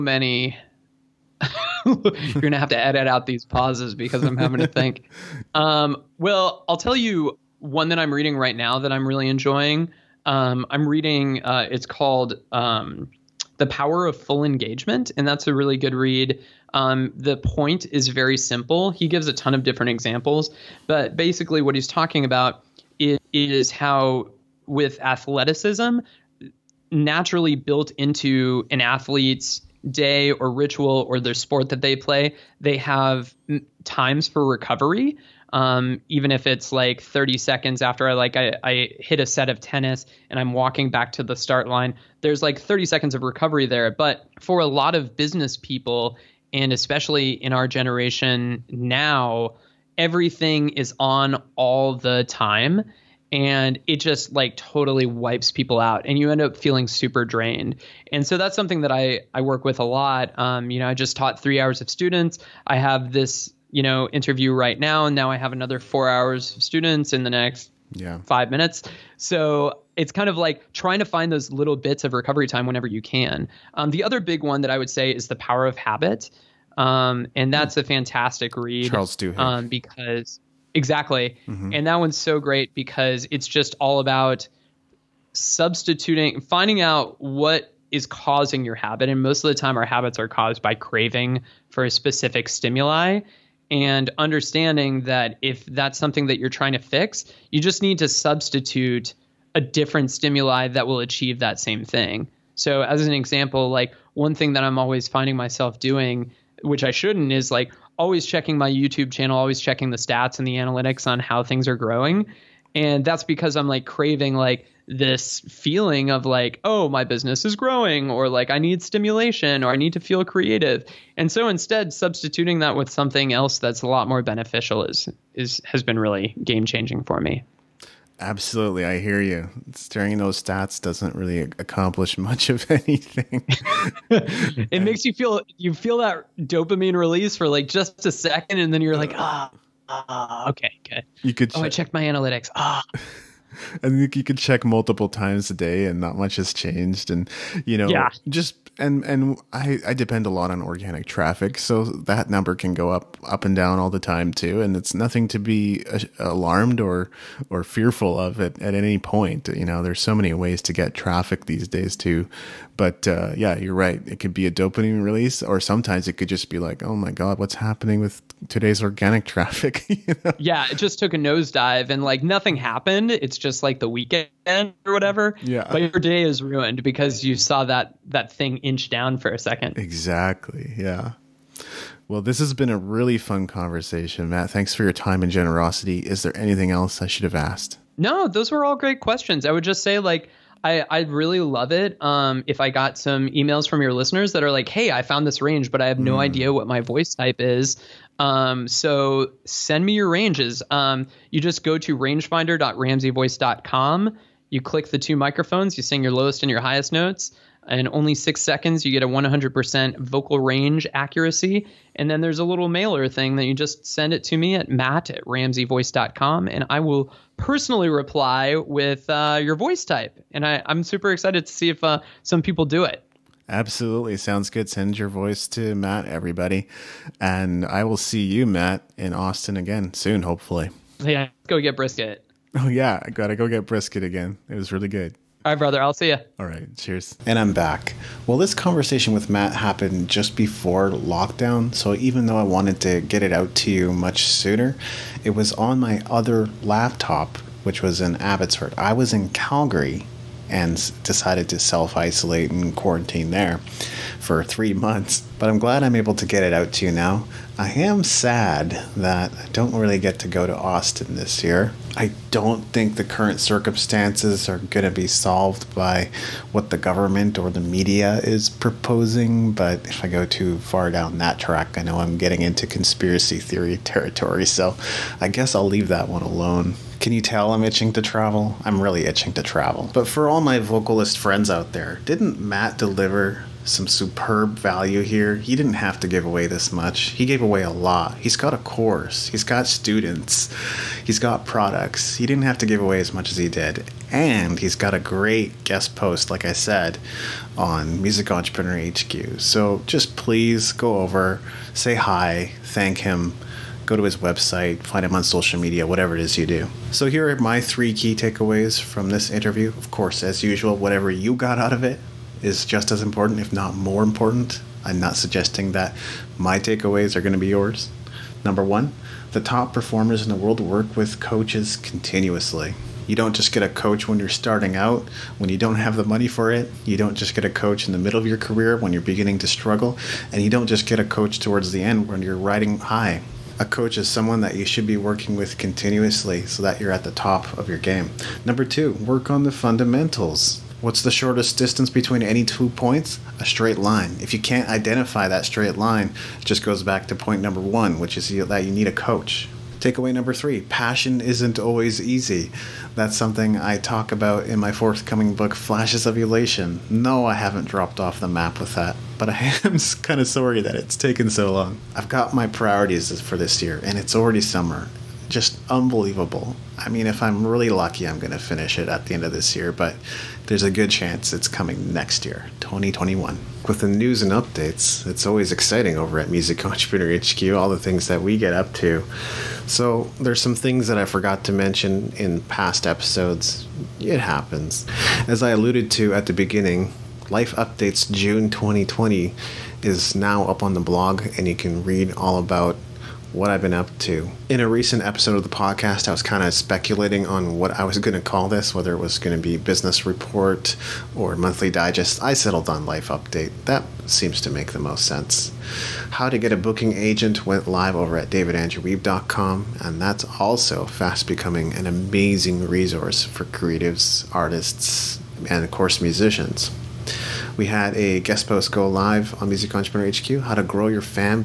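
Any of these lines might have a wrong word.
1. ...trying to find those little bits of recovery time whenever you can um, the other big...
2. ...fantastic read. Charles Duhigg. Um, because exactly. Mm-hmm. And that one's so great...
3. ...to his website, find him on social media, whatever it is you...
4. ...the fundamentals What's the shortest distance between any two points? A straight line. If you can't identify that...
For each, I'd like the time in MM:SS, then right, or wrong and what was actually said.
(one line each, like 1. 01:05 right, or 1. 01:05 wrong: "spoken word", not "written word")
1. 01:10 right
2. 01:17 right
3. 05:03 right
4. 05:39 right.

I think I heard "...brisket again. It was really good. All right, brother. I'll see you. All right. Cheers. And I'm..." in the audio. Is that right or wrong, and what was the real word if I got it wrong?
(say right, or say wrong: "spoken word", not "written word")
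right.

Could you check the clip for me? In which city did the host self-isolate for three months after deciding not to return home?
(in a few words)
Calgary.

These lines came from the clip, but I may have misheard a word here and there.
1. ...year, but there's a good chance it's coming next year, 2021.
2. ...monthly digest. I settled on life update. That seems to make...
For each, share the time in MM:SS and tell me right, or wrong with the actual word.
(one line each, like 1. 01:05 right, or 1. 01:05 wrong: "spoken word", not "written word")
1. 06:09 right
2. 06:41 right.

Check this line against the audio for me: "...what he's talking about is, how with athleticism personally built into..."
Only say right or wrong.
wrong.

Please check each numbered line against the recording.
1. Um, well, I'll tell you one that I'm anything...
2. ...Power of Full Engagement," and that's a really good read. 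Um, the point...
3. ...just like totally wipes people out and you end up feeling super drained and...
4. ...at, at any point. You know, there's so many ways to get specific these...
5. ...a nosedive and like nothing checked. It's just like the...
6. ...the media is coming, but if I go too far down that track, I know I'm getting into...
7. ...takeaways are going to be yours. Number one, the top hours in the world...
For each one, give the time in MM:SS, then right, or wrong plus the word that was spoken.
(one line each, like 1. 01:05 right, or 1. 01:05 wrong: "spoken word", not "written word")
1. 00:05 wrong: "reading", not "anything"
2. 00:13 right
3. 00:53 right
4. 02:38 wrong: "traffic", not "specific"
5. 02:51 wrong: "happened", not "checked"
6. 04:27 wrong: "proposing", not "coming"
7. 05:16 wrong: "performers", not "hours".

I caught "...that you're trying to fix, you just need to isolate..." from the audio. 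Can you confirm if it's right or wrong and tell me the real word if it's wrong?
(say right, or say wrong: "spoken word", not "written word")
wrong: "substitute", not "isolate".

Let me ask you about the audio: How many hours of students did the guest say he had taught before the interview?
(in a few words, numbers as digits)
3.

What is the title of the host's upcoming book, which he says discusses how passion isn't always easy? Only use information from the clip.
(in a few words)
Flashes of Elation.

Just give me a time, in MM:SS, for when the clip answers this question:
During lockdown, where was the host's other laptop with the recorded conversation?
04:08.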